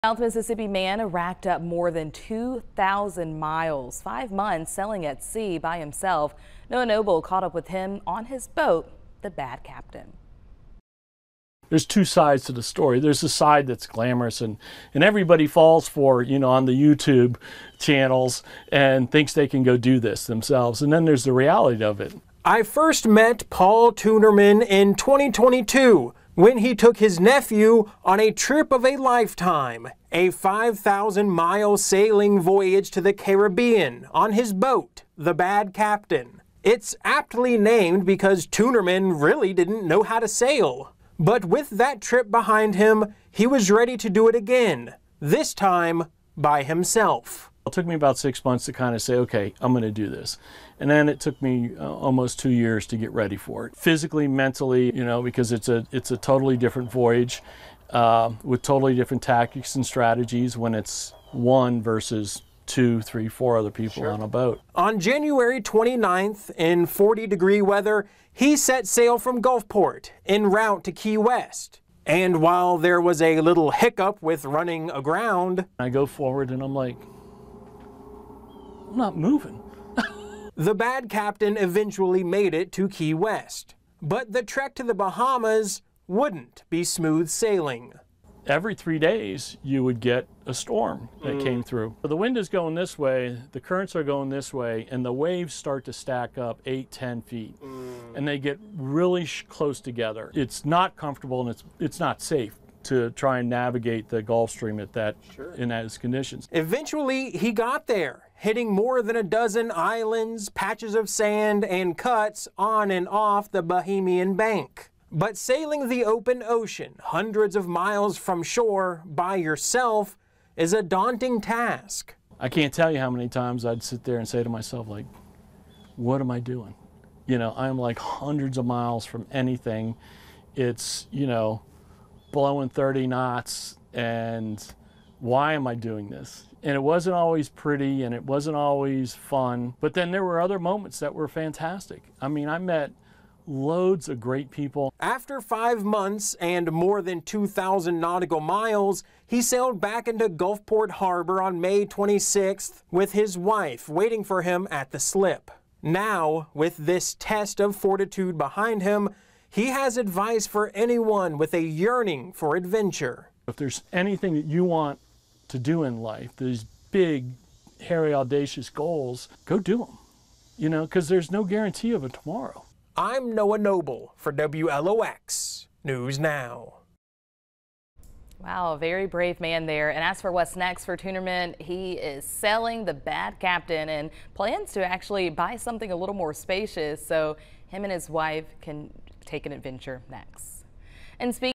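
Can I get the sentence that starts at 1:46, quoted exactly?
Eventually, he got there hitting more than a dozen islands, patches of sand, and cuts on and off the Bahamian Bank.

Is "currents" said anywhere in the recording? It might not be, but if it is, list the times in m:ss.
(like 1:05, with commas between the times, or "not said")
1:33.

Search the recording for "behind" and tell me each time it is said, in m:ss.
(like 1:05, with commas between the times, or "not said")
0:42, 2:38.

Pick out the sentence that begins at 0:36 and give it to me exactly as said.
It's aptly named because Tunerman really didn't know how to sail.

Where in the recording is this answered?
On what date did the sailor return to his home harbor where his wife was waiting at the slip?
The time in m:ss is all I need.
2:31.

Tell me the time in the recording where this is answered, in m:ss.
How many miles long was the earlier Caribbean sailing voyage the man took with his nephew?
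0:30.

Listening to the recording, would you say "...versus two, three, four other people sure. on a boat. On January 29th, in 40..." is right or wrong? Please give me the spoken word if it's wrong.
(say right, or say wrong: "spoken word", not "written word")
right.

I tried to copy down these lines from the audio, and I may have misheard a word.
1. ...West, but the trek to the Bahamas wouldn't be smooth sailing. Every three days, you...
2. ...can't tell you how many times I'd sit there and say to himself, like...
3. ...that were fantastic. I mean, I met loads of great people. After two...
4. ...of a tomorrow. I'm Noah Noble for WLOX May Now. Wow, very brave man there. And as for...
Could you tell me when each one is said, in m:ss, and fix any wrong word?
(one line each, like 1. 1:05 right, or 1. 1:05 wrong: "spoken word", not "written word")
1. 1:23 right
2. 2:02 wrong: "myself", not "himself"
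3. 2:20 wrong: "five", not "two"
4. 2:51 wrong: "News", not "May".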